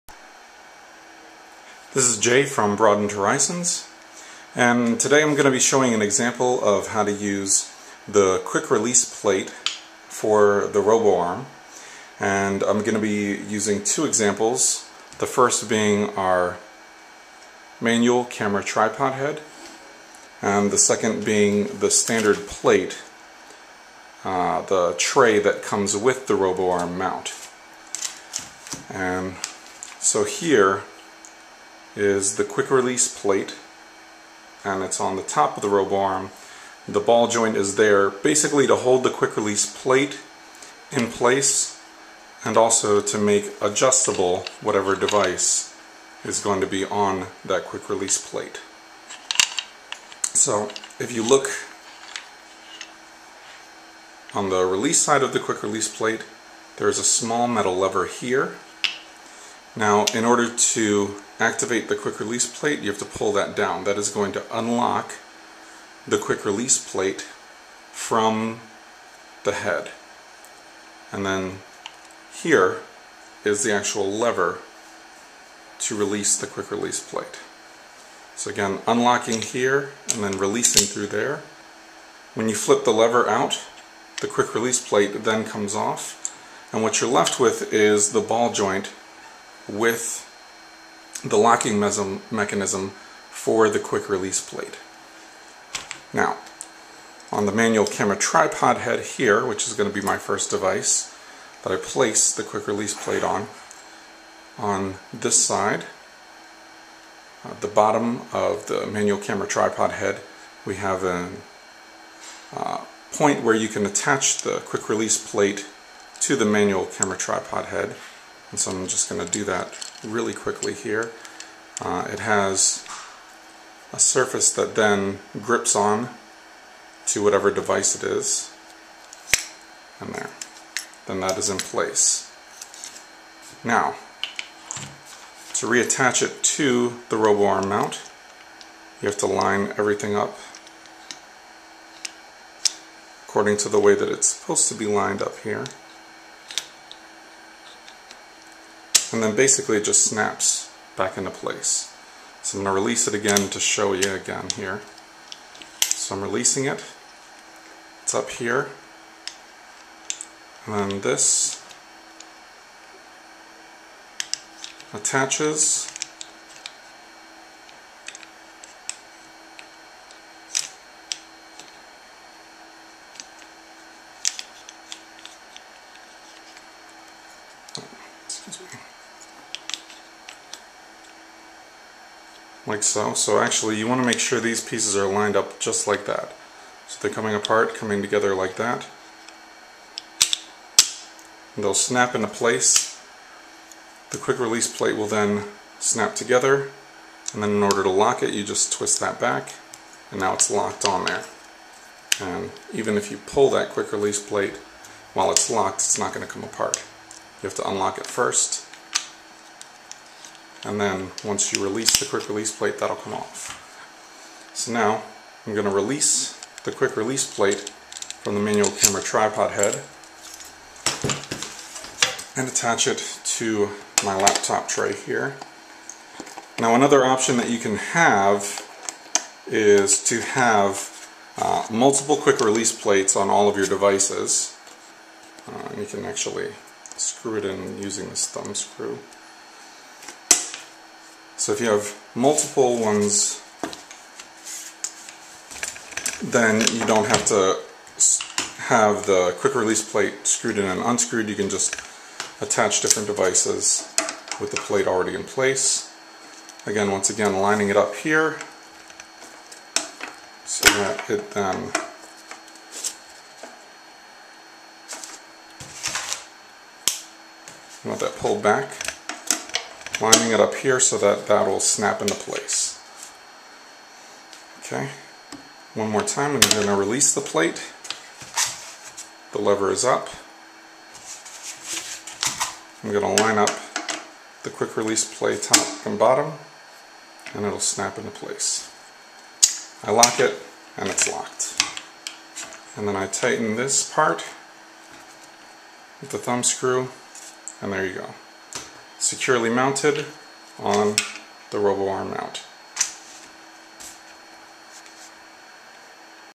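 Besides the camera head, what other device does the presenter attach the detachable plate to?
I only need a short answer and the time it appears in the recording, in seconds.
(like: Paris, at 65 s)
laptop tray, at 224 s.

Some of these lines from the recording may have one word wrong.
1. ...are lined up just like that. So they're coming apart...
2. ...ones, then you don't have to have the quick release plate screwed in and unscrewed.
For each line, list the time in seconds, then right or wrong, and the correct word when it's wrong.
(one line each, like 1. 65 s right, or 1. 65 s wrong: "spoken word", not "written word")
1. 184 s right
2. 242 s right.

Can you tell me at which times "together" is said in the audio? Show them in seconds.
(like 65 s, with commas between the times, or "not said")
188 s, 196 s.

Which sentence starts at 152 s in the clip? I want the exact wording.
So I'm going to release it again to show you again here.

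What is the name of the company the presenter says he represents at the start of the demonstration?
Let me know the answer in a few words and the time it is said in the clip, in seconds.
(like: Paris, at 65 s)
Broadened Horizons, at 2 s.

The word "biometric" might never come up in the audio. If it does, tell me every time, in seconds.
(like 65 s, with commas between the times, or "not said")
not said.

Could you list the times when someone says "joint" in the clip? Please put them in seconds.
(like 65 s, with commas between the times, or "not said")
37 s, 88 s.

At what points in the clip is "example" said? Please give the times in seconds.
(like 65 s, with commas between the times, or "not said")
6 s, 14 s.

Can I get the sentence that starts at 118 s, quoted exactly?
And so I'm just going to do that really quickly here.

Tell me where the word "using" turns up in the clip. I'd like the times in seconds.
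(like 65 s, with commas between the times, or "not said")
13 s, 237 s.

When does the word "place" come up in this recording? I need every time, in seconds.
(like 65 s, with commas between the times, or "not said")
41 s, 101 s, 131 s, 151 s, 192 s, 255 s, 272 s, 288 s.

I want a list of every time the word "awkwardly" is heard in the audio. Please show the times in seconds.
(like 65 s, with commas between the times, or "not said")
not said.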